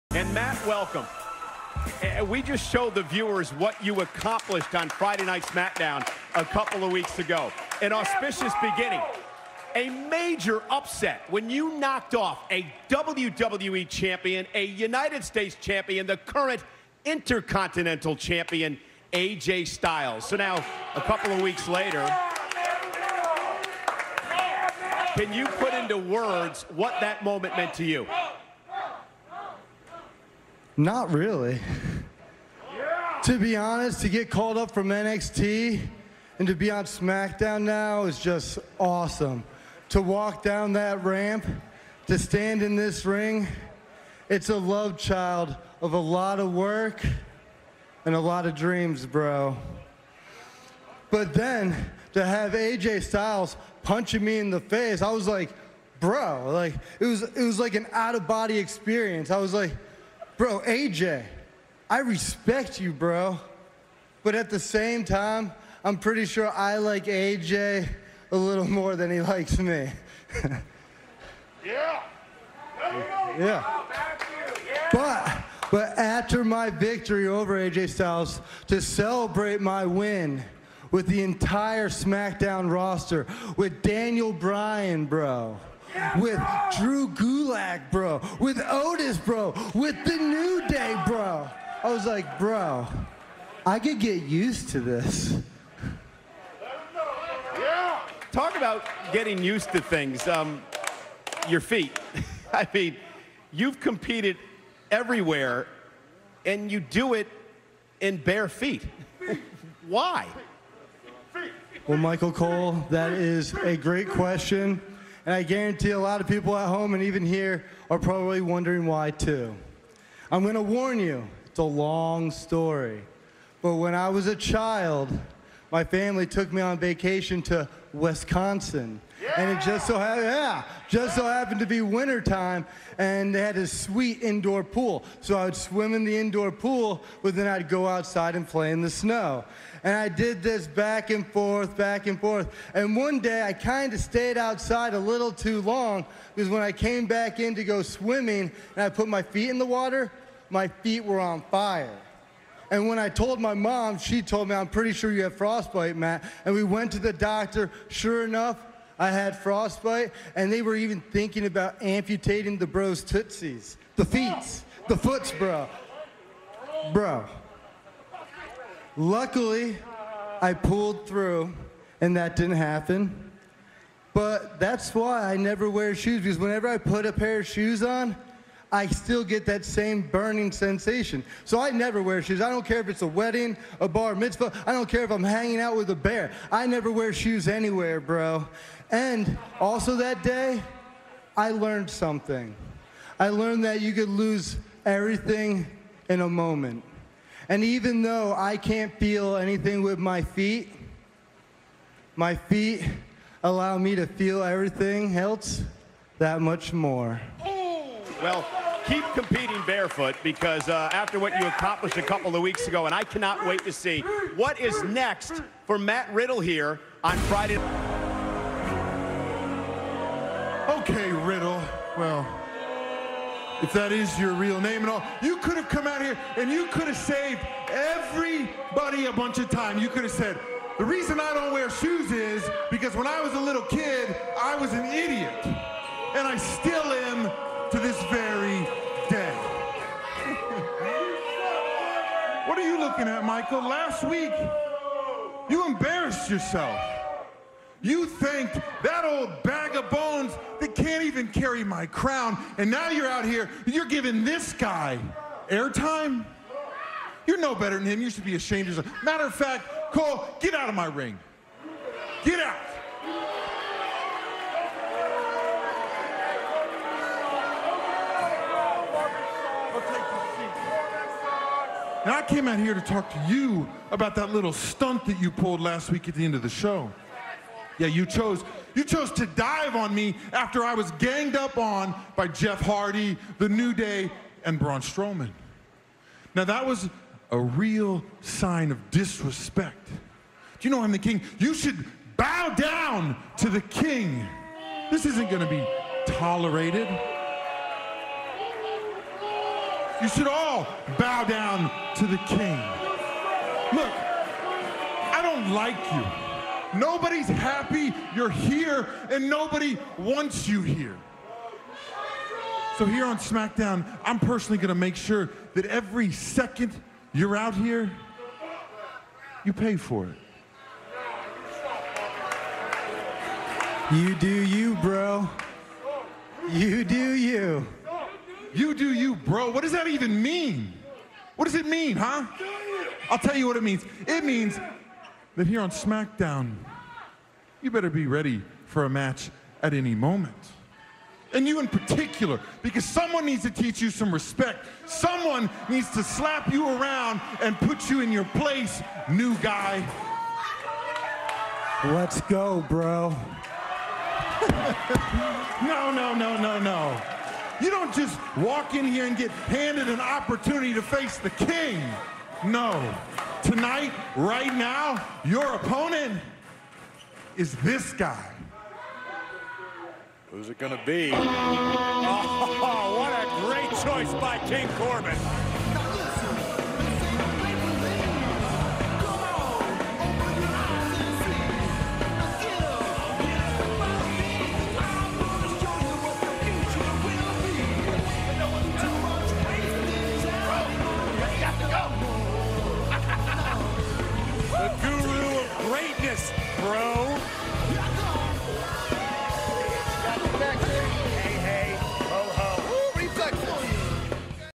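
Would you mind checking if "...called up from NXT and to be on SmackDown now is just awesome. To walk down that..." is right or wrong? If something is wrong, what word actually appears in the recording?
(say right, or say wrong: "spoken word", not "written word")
right.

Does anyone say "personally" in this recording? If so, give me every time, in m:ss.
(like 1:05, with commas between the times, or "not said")
5:14.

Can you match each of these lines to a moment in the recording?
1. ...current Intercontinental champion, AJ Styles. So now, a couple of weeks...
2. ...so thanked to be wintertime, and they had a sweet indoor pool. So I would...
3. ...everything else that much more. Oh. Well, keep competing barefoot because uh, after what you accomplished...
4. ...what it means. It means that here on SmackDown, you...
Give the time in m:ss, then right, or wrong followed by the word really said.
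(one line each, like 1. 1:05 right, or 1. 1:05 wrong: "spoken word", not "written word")
1. 0:16 right
2. 2:11 wrong: "happened", not "thanked"
3. 3:24 right
4. 5:33 right.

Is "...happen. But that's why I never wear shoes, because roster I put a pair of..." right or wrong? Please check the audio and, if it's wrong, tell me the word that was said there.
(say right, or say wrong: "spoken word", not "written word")
wrong: "whenever", not "roster".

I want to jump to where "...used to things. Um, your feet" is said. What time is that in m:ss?
1:39.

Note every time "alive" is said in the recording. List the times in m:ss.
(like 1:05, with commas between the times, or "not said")
not said.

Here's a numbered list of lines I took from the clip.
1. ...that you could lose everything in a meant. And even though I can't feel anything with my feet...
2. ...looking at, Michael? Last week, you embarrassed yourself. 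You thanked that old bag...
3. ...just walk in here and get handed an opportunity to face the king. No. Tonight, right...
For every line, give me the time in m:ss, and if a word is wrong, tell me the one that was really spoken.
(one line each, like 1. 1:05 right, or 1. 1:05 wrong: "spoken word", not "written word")
1. 3:13 wrong: "moment", not "meant"
2. 4:02 right
3. 5:57 right.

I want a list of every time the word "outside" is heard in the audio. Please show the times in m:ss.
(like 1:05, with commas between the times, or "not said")
2:17, 2:24.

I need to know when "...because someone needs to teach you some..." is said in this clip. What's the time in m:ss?
5:42.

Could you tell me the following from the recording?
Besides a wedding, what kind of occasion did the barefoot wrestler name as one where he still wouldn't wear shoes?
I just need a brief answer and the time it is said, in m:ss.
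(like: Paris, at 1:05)
Bar mitzvah, at 3:03.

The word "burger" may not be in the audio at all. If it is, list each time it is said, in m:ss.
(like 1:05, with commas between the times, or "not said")
not said.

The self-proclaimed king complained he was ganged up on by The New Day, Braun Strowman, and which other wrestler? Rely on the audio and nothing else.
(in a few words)
Jeff Hardy.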